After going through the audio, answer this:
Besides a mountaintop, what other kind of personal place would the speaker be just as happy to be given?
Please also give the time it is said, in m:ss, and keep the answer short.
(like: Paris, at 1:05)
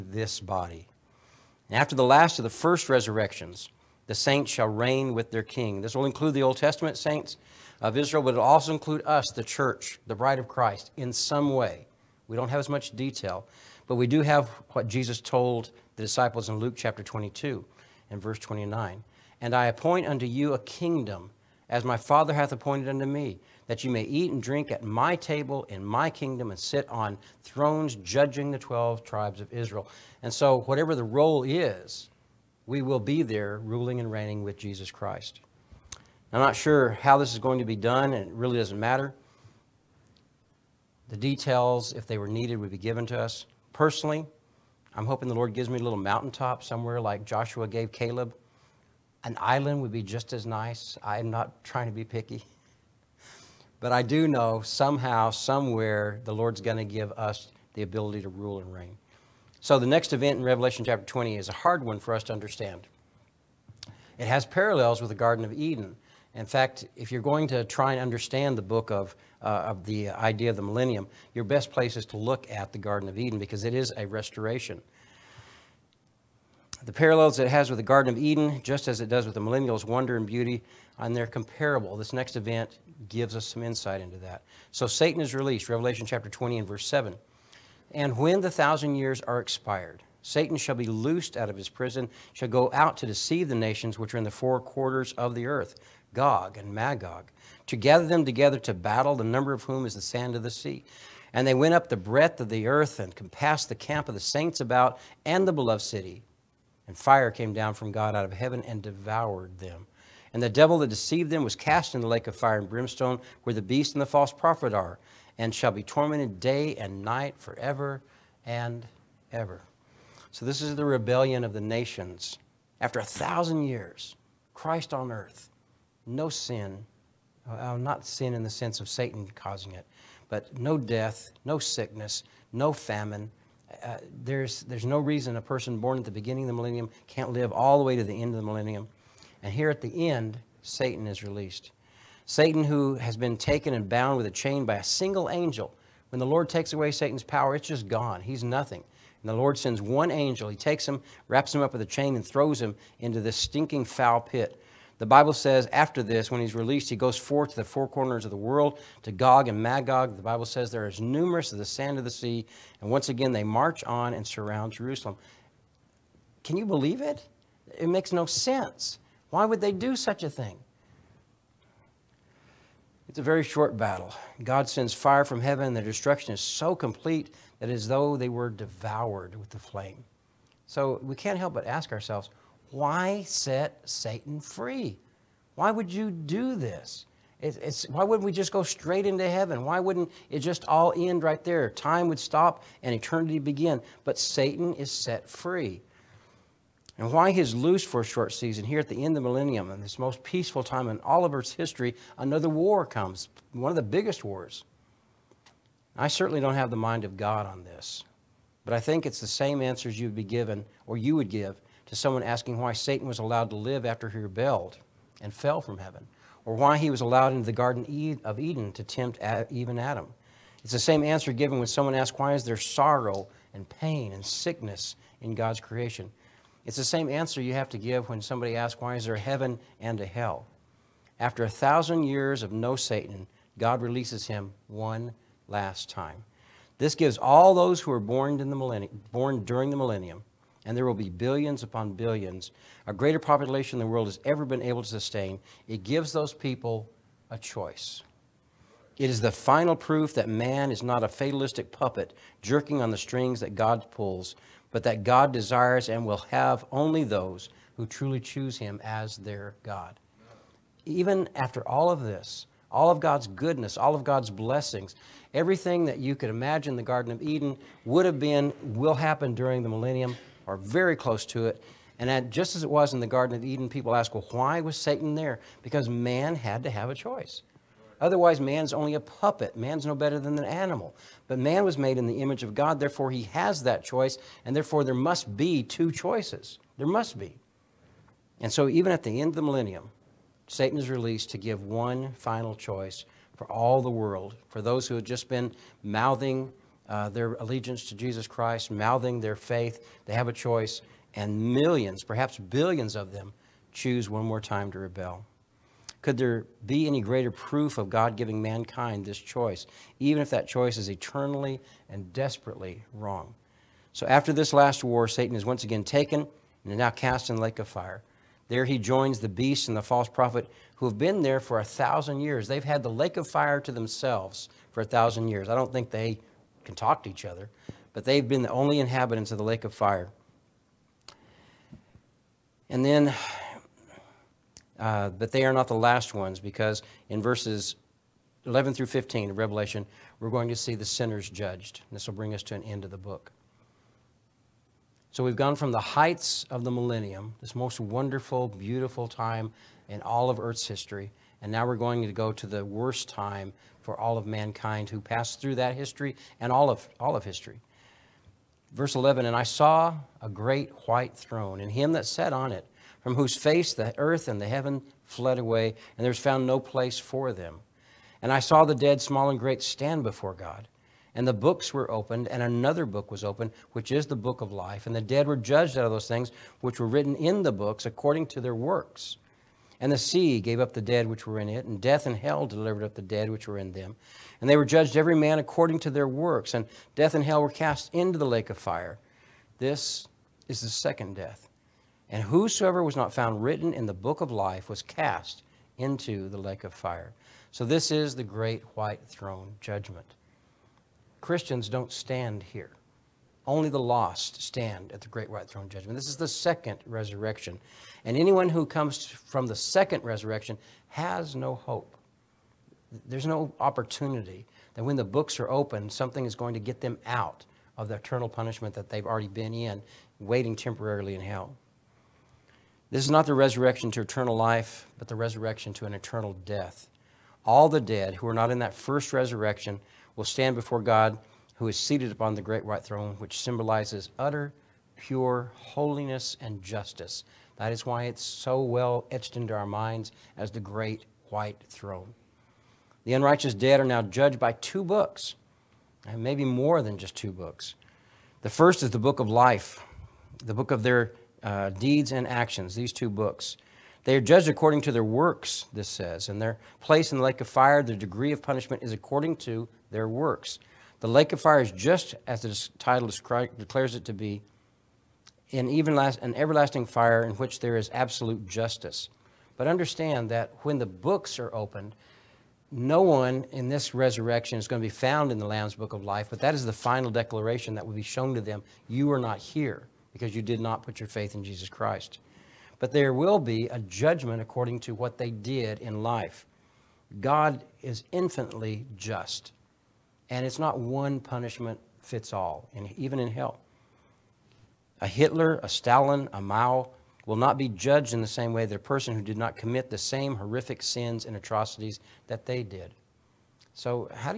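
an island, at 0:49.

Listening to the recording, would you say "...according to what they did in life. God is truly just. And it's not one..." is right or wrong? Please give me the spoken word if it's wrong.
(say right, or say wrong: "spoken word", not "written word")
wrong: "infinitely", not "truly".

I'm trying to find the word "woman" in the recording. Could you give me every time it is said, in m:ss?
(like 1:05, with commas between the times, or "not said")
not said.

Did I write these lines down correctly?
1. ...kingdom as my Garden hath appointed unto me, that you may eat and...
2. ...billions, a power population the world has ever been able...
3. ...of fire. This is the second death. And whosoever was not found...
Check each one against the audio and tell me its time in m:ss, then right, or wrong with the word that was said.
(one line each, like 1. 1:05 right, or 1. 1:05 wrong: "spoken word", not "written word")
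1. 0:20 wrong: "Father", not "Garden"
2. 4:01 wrong: "greater", not "power"
3. 6:28 right.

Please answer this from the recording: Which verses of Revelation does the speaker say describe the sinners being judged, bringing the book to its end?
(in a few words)
11 through 15.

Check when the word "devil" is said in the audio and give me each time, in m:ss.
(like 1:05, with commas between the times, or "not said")
1:50.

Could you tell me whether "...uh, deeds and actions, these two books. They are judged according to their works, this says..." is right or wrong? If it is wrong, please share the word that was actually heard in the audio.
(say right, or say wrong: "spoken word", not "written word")
right.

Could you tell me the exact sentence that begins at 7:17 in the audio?
That is why it's so well etched into our minds as the great white throne.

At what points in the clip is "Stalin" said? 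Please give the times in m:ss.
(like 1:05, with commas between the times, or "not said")
8:15.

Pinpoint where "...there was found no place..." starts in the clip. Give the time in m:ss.
6:06.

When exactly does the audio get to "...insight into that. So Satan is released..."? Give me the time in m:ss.
1:23.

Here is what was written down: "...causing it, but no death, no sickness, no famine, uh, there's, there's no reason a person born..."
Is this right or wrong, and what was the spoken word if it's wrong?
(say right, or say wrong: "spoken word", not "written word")
right.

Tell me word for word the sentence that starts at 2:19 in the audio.
And here at the end, Satan is released.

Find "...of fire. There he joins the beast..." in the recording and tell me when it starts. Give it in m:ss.
5:17.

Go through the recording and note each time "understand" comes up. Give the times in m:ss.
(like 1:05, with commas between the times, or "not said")
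1:02, 1:08, 7:49.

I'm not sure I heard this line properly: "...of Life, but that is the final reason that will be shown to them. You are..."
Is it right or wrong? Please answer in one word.
wrong.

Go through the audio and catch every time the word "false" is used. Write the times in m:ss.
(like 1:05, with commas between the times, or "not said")
1:54, 5:19.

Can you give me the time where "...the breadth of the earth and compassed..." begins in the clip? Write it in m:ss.
1:41.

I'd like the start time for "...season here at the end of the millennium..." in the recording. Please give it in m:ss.
3:18.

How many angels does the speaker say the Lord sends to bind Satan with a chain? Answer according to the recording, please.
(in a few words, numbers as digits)
1.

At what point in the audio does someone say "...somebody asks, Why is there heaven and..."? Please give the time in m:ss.
3:48.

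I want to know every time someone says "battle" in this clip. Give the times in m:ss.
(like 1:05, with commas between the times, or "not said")
1:38, 2:53.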